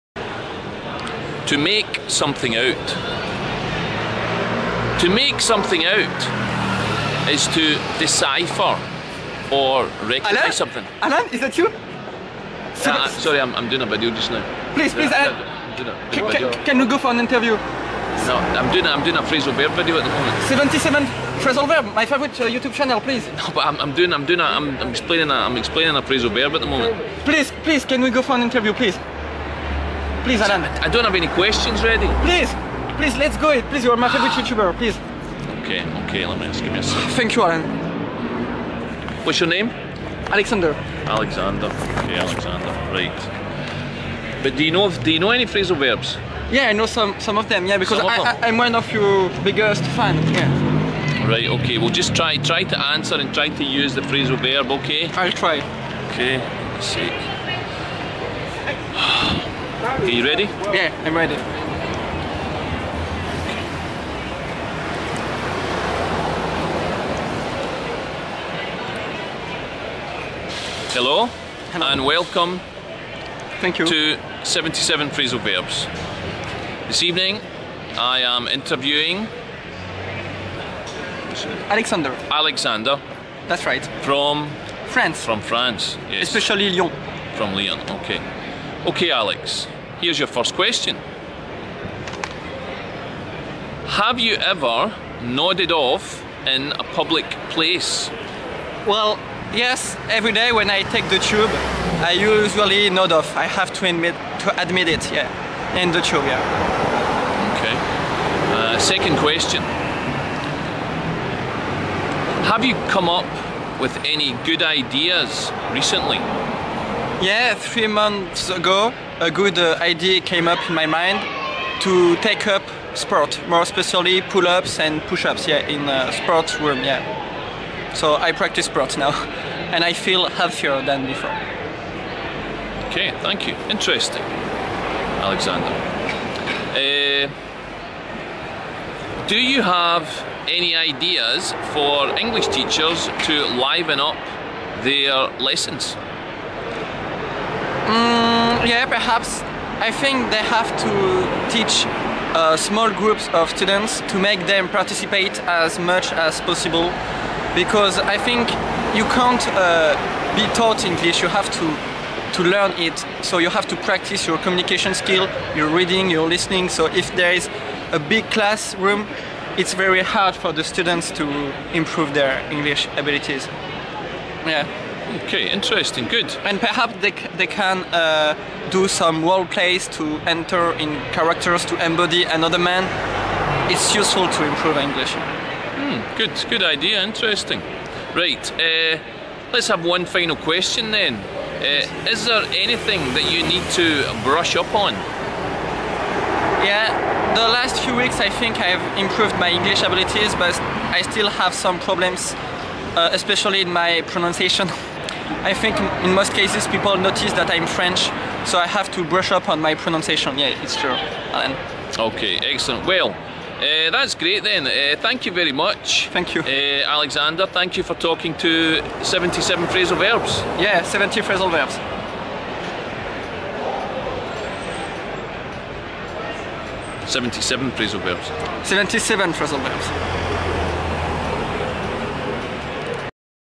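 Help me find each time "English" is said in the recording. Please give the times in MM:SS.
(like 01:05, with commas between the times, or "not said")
02:22, 02:40, 02:52, 03:04, 03:19.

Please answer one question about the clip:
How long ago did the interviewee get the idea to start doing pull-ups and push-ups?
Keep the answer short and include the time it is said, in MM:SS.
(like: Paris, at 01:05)
3 months ago, at 01:57.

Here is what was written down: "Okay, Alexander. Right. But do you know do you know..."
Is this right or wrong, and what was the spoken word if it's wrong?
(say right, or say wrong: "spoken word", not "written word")
right.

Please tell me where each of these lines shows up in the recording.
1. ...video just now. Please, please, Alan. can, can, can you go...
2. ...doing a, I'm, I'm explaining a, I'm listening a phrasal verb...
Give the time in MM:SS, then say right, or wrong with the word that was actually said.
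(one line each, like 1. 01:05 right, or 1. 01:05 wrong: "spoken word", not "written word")
1. 00:13 right
2. 00:24 wrong: "explaining", not "listening".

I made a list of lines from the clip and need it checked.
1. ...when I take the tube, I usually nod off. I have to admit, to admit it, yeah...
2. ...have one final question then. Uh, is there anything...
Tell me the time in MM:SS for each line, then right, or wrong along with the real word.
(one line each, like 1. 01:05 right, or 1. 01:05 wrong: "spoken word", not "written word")
1. 01:40 right
2. 03:09 right.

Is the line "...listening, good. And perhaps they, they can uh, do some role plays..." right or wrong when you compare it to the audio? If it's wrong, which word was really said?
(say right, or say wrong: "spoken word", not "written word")
wrong: "interesting", not "listening".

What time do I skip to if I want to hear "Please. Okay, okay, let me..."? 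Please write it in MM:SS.
00:34.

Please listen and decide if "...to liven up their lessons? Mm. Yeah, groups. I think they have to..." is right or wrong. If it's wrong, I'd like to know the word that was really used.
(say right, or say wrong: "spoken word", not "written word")
wrong: "perhaps", not "groups".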